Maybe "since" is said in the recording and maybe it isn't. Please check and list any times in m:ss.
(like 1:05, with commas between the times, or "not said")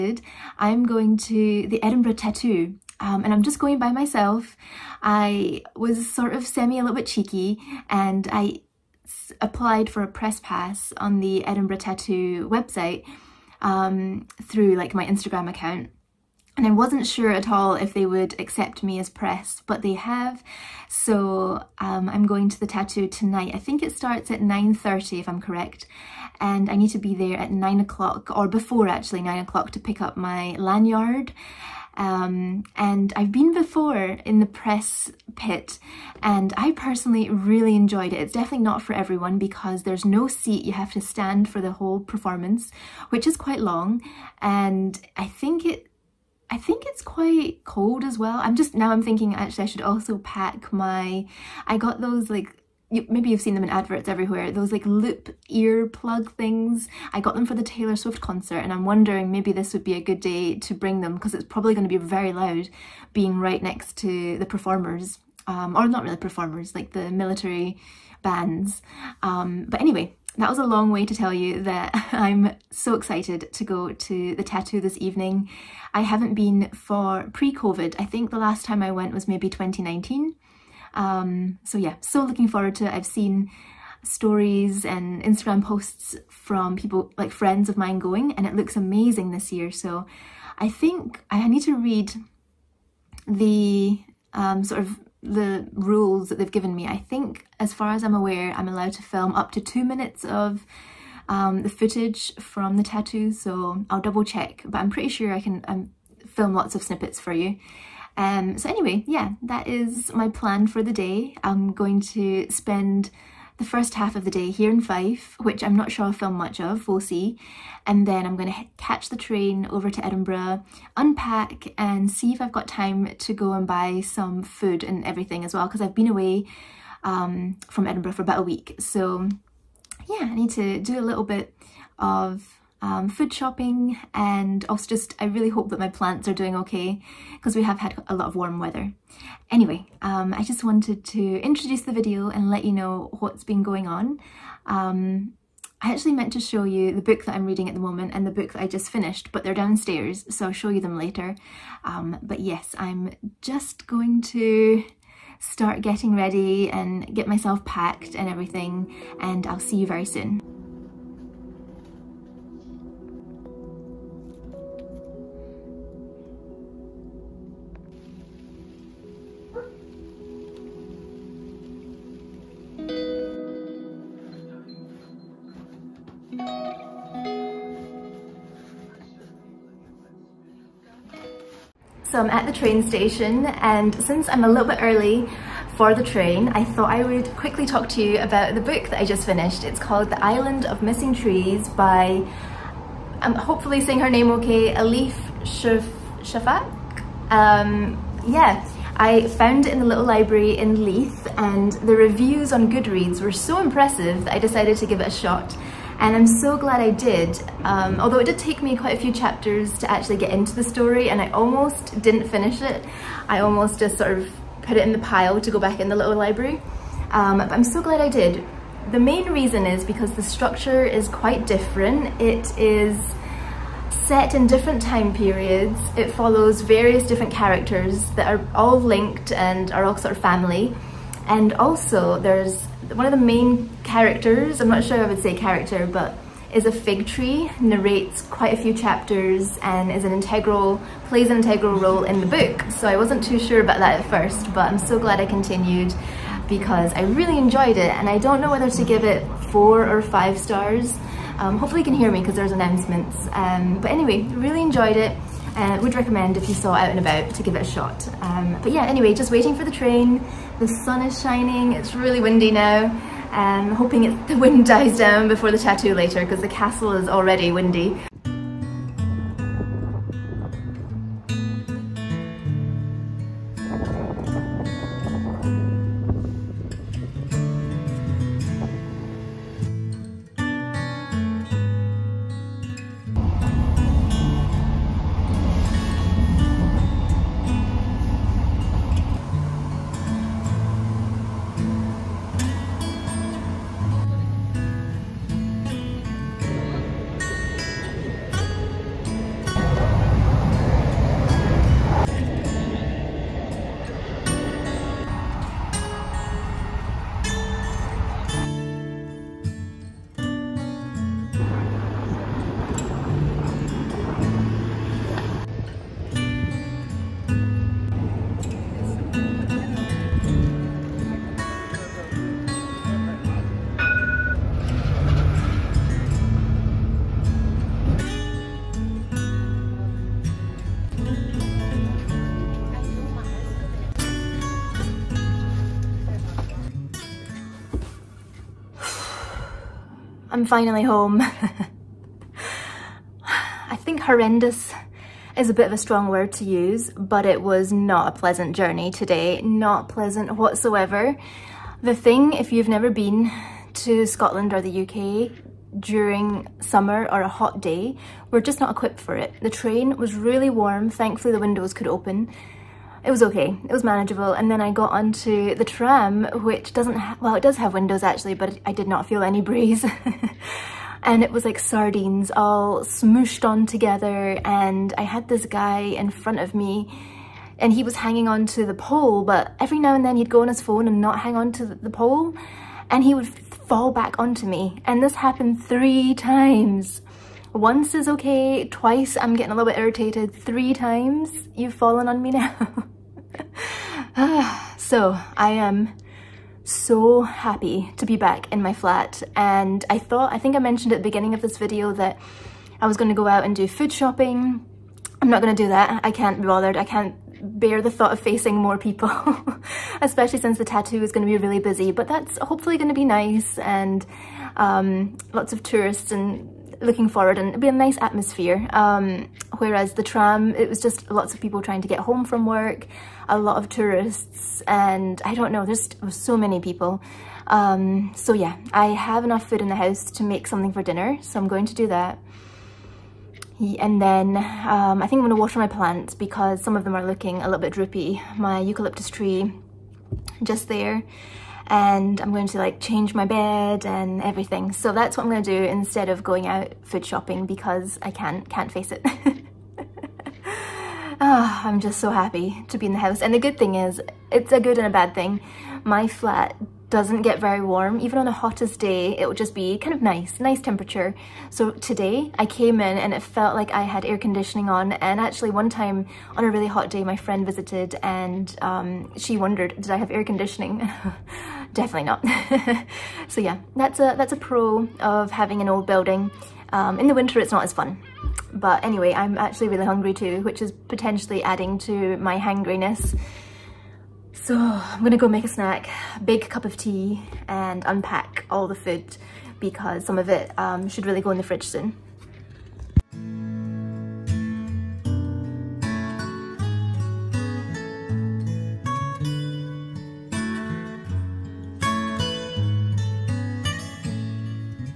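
3:04, 6:50.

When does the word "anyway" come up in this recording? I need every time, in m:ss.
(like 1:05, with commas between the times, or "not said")
1:09, 1:48, 2:19, 4:13, 4:18, 7:58.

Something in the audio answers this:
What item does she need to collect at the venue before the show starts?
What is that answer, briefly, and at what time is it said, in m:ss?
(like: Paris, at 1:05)
lanyard, at 0:30.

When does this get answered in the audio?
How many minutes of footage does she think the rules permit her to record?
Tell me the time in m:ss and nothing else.
1:39.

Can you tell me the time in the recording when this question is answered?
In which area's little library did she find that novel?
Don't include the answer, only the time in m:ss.
3:20.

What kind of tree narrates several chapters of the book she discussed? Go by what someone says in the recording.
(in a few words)
fig tree.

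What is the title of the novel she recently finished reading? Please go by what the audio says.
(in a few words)
The Island of Missing Trees.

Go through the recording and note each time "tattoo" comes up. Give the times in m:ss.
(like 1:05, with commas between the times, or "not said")
0:02, 0:11, 0:22, 1:14, 1:42, 4:25, 6:50.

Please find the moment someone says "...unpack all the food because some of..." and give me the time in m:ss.
8:07.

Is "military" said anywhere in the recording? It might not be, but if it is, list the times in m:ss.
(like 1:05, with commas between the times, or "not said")
1:07.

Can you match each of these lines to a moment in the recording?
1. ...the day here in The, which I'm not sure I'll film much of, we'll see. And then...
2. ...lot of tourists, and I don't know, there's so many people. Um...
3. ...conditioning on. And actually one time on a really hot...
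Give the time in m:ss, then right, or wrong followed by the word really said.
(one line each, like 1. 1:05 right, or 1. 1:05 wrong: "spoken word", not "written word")
1. 1:54 wrong: "Fife", not "The"
2. 7:03 right
3. 7:44 right.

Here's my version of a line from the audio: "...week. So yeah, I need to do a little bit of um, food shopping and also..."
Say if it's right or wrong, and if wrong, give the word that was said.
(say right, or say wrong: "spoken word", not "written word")
right.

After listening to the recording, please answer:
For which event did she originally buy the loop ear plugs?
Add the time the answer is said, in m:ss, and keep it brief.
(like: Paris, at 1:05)
Taylor Swift concert, at 0:57.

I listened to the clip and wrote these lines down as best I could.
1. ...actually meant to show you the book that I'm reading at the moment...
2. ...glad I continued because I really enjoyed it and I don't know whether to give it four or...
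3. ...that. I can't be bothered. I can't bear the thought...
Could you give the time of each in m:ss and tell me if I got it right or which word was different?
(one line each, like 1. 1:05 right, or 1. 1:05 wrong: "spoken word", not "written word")
1. 2:25 right
2. 4:04 right
3. 6:45 right.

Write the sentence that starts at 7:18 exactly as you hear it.
My eucalyptus tree just there and I'm going to like change my bed and everything.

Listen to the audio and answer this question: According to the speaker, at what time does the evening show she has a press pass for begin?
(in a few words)
9:30.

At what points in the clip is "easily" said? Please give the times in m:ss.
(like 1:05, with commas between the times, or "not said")
not said.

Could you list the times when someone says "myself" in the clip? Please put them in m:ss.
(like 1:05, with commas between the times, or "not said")
0:03, 2:37.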